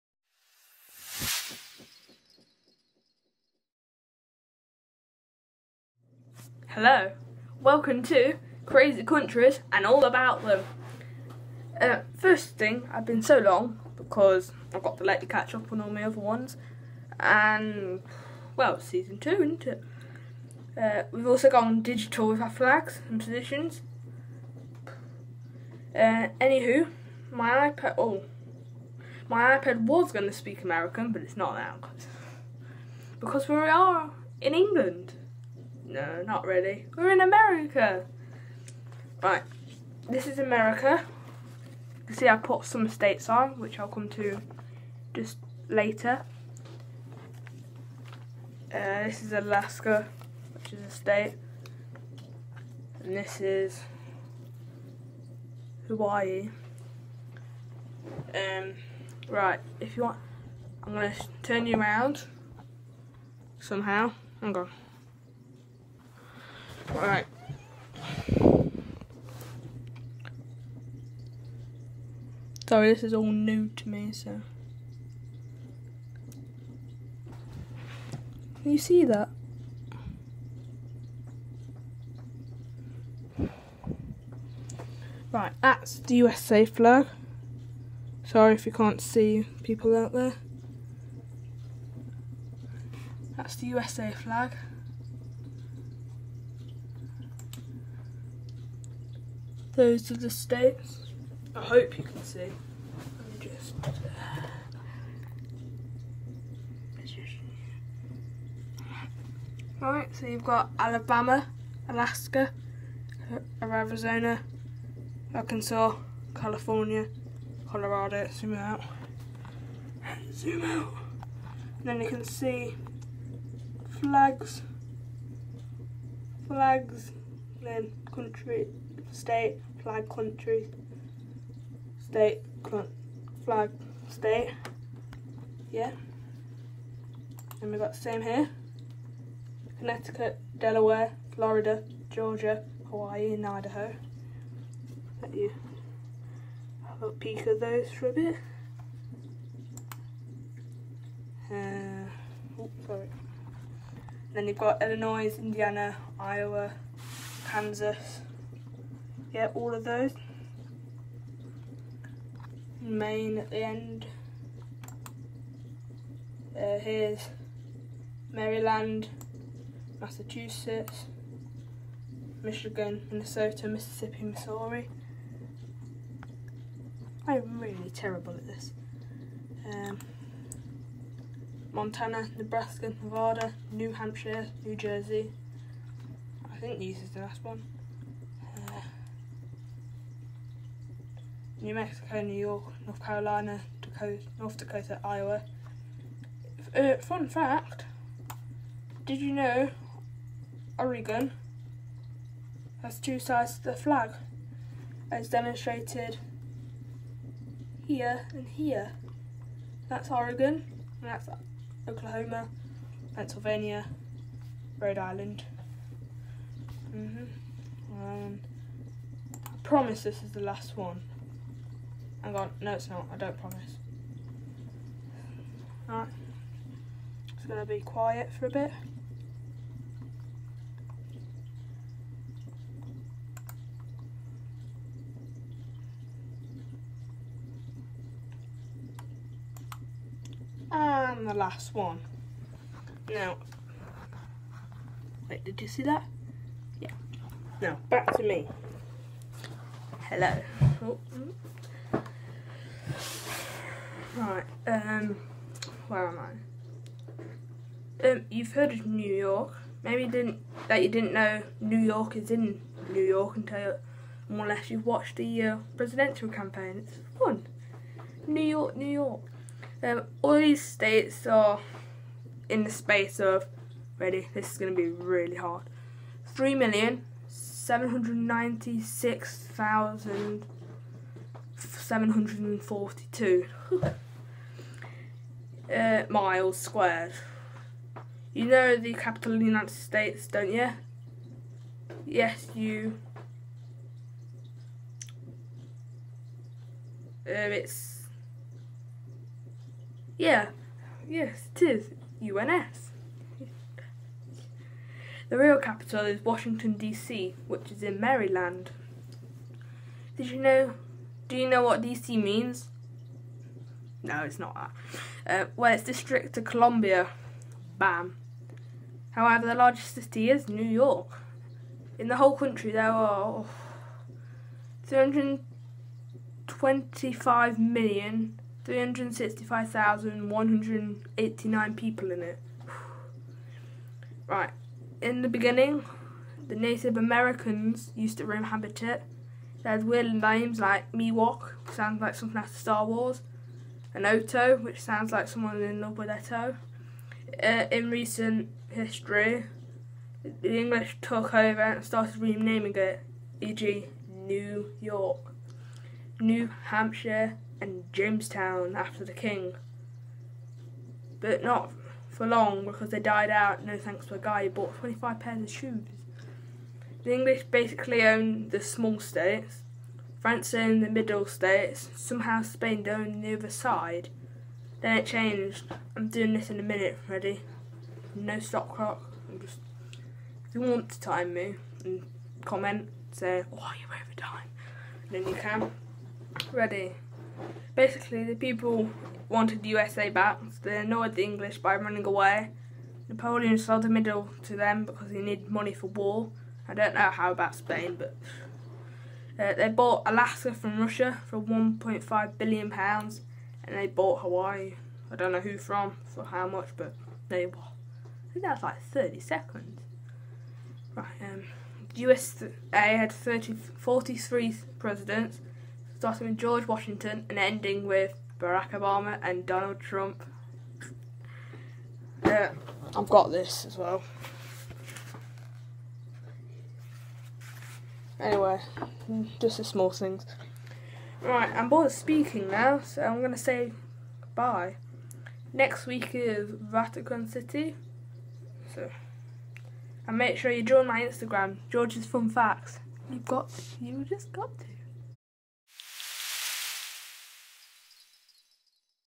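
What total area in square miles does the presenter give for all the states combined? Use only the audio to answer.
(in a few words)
3,796,742.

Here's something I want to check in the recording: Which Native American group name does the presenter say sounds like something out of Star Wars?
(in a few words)
Miwok.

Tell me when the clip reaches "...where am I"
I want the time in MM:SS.
04:15.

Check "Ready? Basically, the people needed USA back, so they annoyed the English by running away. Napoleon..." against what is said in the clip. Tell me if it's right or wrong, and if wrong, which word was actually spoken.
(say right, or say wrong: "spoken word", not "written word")
wrong: "wanted", not "needed".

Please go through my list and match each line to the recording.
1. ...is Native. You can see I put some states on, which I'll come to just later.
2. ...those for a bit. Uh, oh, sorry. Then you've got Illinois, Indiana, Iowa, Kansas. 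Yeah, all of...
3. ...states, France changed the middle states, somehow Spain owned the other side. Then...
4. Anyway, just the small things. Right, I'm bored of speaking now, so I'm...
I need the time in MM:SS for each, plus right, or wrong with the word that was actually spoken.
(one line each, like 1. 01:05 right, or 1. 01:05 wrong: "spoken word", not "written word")
1. 00:40 wrong: "America", not "Native"
2. 02:27 right
3. 06:08 wrong: "owned", not "changed"
4. 07:08 right.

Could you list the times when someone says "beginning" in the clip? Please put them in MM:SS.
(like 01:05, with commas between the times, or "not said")
05:35.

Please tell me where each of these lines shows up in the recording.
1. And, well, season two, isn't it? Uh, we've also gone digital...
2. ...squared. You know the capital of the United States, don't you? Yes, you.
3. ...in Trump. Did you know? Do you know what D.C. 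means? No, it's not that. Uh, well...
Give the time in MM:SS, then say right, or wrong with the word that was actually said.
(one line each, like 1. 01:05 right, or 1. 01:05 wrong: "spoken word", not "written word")
1. 00:17 right
2. 04:46 right
3. 05:07 wrong: "Maryland", not "Trump".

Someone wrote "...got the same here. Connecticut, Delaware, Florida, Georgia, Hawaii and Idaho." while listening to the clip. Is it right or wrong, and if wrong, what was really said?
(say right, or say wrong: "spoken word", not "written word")
right.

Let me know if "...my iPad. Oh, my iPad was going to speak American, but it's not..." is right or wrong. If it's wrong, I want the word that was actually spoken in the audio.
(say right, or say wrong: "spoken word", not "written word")
right.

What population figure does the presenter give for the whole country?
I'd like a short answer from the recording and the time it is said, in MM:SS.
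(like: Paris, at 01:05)
325,365,189, at 05:24.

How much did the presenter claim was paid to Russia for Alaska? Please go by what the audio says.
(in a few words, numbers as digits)
1.5 billion pounds.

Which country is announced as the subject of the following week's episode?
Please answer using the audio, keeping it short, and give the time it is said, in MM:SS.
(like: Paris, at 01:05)
Vatican City, at 07:16.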